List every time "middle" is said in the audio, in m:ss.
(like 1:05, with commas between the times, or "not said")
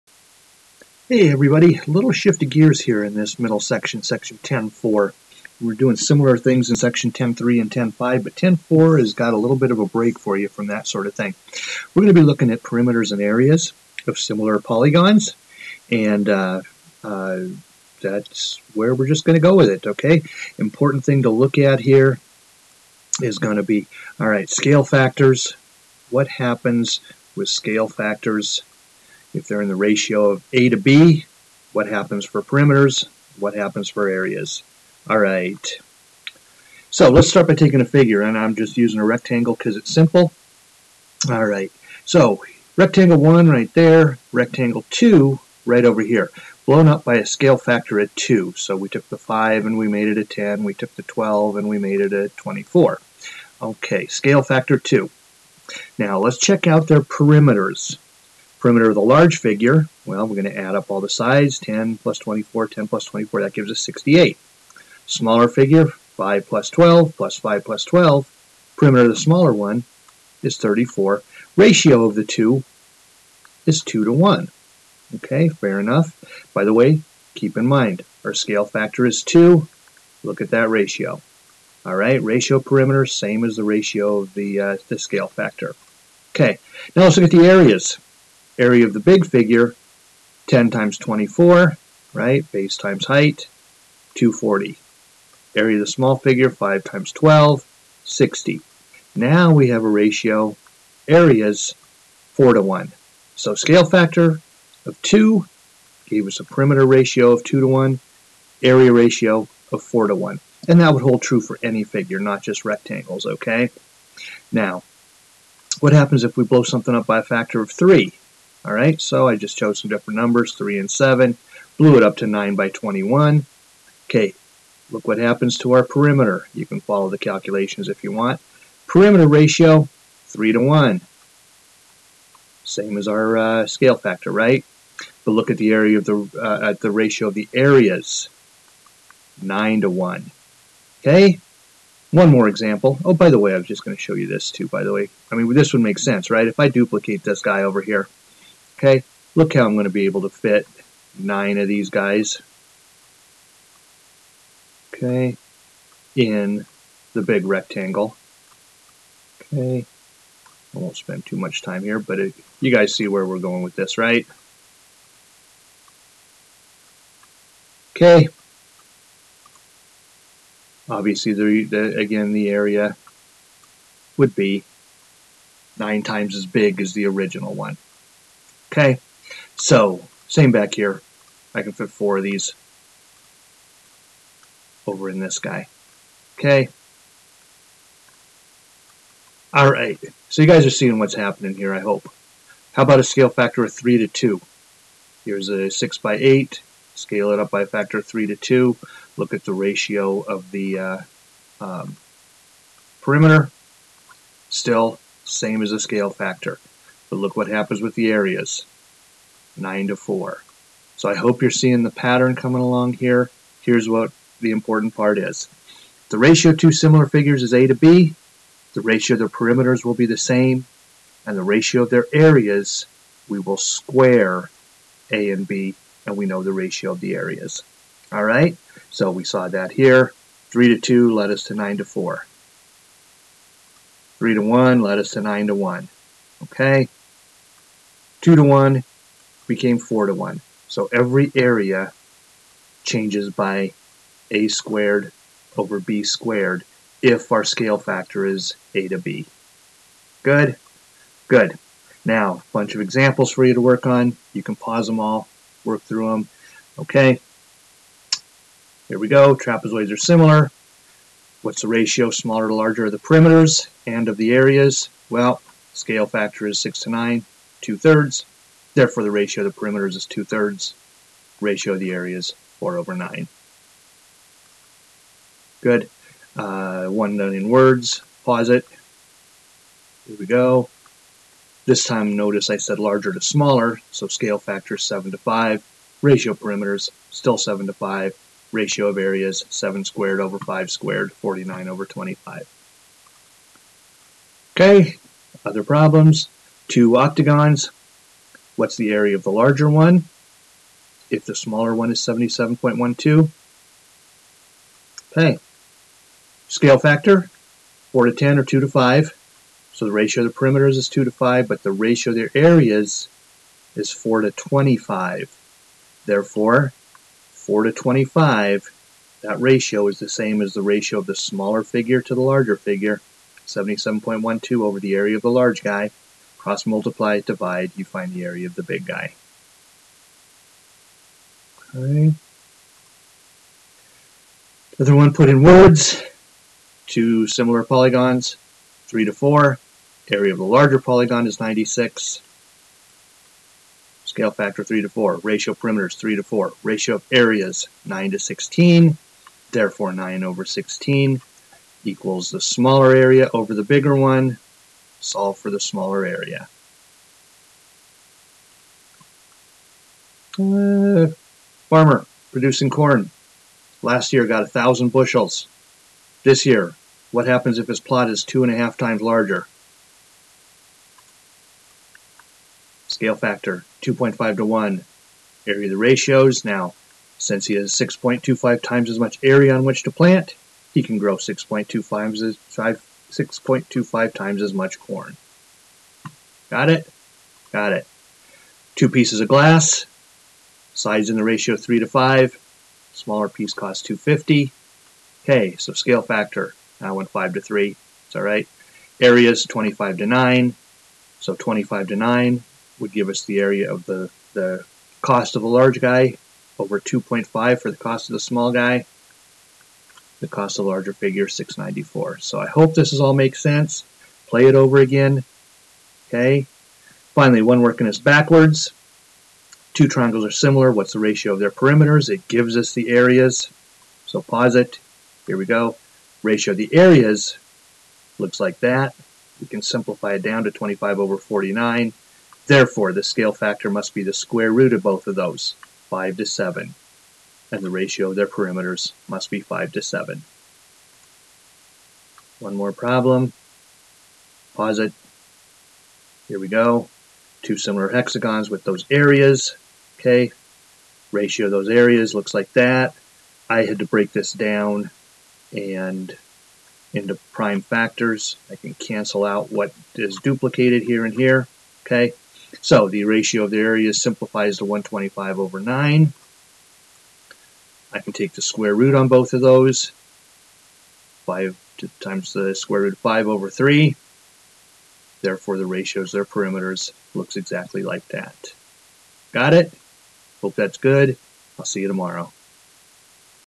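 0:03.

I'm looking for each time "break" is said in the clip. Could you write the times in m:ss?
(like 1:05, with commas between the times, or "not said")
0:09, 7:33.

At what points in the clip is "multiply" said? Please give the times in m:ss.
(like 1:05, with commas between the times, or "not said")
5:26.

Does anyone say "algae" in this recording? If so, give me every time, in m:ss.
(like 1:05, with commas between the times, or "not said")
not said.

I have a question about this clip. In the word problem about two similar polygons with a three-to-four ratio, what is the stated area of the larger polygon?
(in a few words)
96.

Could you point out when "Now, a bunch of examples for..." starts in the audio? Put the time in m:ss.
4:12.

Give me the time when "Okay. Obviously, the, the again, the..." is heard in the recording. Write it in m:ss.
2:47.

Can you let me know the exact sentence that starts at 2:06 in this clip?
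You can follow the calculations if you want.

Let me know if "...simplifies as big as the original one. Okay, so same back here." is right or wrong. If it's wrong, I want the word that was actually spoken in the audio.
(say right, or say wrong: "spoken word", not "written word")
wrong: "times", not "simplifies".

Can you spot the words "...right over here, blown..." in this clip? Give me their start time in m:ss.
0:45.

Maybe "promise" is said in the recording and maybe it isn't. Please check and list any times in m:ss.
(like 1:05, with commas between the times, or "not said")
not said.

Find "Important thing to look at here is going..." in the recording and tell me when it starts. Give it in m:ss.
0:20.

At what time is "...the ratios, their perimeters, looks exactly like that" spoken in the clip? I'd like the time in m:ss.
7:55.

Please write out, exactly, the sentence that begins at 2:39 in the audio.
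Okay, I won't spend too much time here, but it, you guys see where we're going with this, right?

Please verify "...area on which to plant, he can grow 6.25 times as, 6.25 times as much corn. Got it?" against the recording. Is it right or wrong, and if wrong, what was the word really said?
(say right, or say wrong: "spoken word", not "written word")
right.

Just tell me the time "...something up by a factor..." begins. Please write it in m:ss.
1:56.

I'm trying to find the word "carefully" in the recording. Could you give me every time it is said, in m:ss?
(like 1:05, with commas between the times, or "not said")
not said.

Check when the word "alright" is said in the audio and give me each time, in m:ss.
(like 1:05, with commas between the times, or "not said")
6:38.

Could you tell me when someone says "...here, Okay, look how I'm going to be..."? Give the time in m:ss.
2:27.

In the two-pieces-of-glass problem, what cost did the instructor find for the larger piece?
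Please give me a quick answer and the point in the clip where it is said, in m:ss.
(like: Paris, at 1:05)
694, at 6:51.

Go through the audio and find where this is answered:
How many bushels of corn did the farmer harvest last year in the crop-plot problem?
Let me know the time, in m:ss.
6:04.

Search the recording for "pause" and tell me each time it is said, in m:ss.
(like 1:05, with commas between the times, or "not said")
4:14, 4:38, 7:04, 7:24.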